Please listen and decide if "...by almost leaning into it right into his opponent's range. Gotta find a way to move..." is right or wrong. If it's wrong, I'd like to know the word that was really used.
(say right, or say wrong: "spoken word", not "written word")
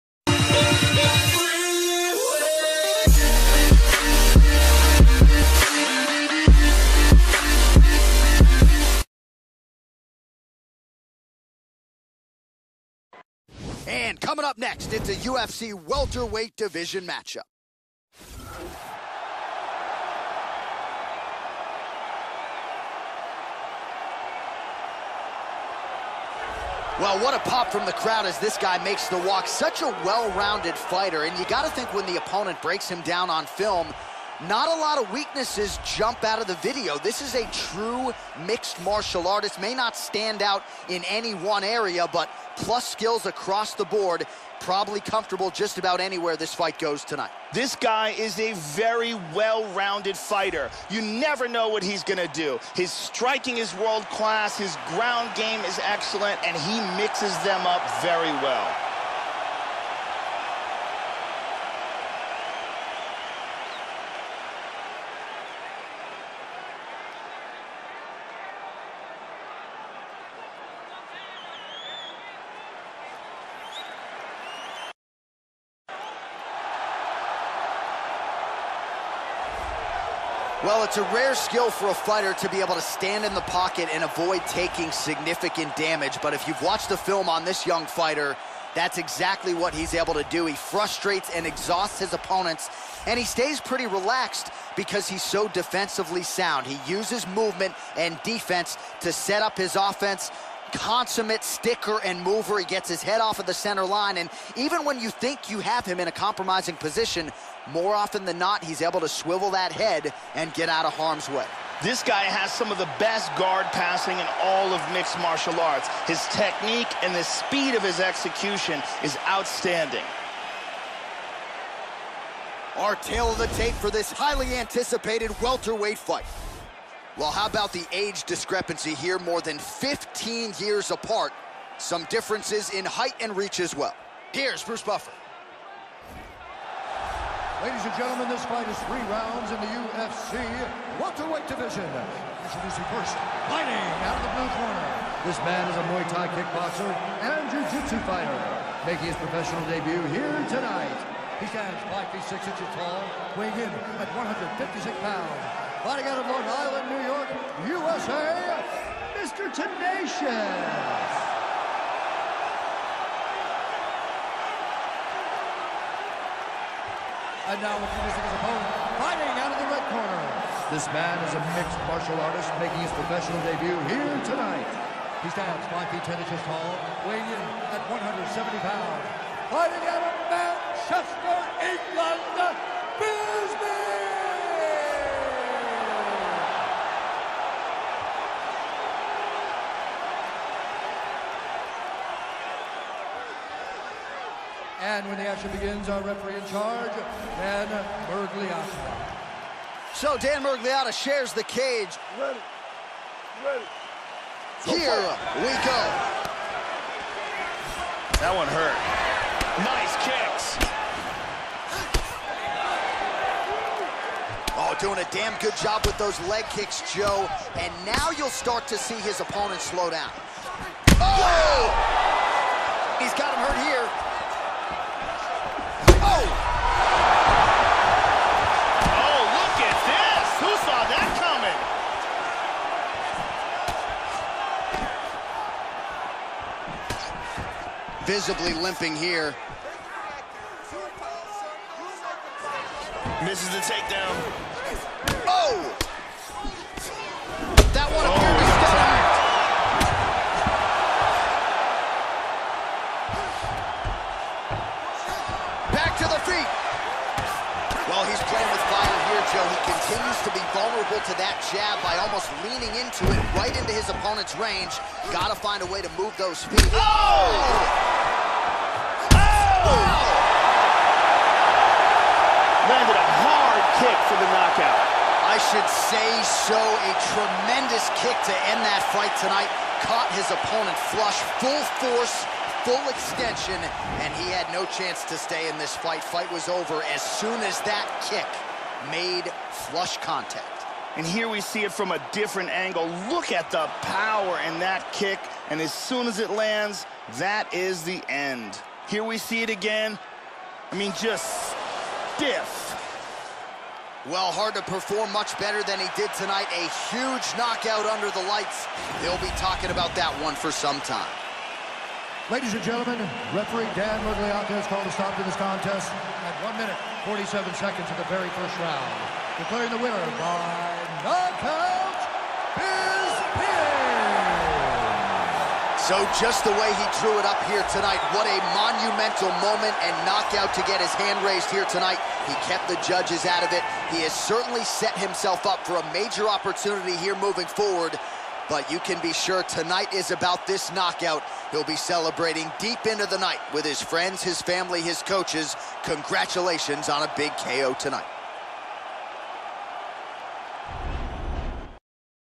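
right.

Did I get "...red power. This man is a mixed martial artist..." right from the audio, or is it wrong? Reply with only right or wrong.
wrong.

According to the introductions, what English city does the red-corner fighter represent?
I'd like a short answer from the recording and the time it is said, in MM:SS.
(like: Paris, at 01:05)
Manchester, at 03:00.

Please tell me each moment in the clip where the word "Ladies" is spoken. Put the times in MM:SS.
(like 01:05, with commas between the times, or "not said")
02:17, 05:12.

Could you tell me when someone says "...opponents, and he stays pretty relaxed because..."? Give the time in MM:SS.
01:32.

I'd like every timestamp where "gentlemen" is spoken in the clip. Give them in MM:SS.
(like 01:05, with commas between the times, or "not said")
02:17, 05:12.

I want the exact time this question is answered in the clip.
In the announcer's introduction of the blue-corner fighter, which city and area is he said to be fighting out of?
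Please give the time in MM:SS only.
02:36.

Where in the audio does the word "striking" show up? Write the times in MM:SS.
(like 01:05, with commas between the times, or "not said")
00:52.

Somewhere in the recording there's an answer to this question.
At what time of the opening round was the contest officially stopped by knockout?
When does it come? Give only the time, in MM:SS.
05:16.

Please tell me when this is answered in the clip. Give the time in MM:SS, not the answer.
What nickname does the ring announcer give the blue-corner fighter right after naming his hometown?
02:39.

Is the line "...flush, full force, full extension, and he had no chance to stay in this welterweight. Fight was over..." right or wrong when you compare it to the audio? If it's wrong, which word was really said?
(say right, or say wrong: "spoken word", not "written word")
wrong: "fight", not "welterweight".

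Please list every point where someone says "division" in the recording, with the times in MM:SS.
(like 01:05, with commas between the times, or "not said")
00:16, 02:21.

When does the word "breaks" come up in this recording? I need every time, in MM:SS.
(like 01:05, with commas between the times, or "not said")
00:32.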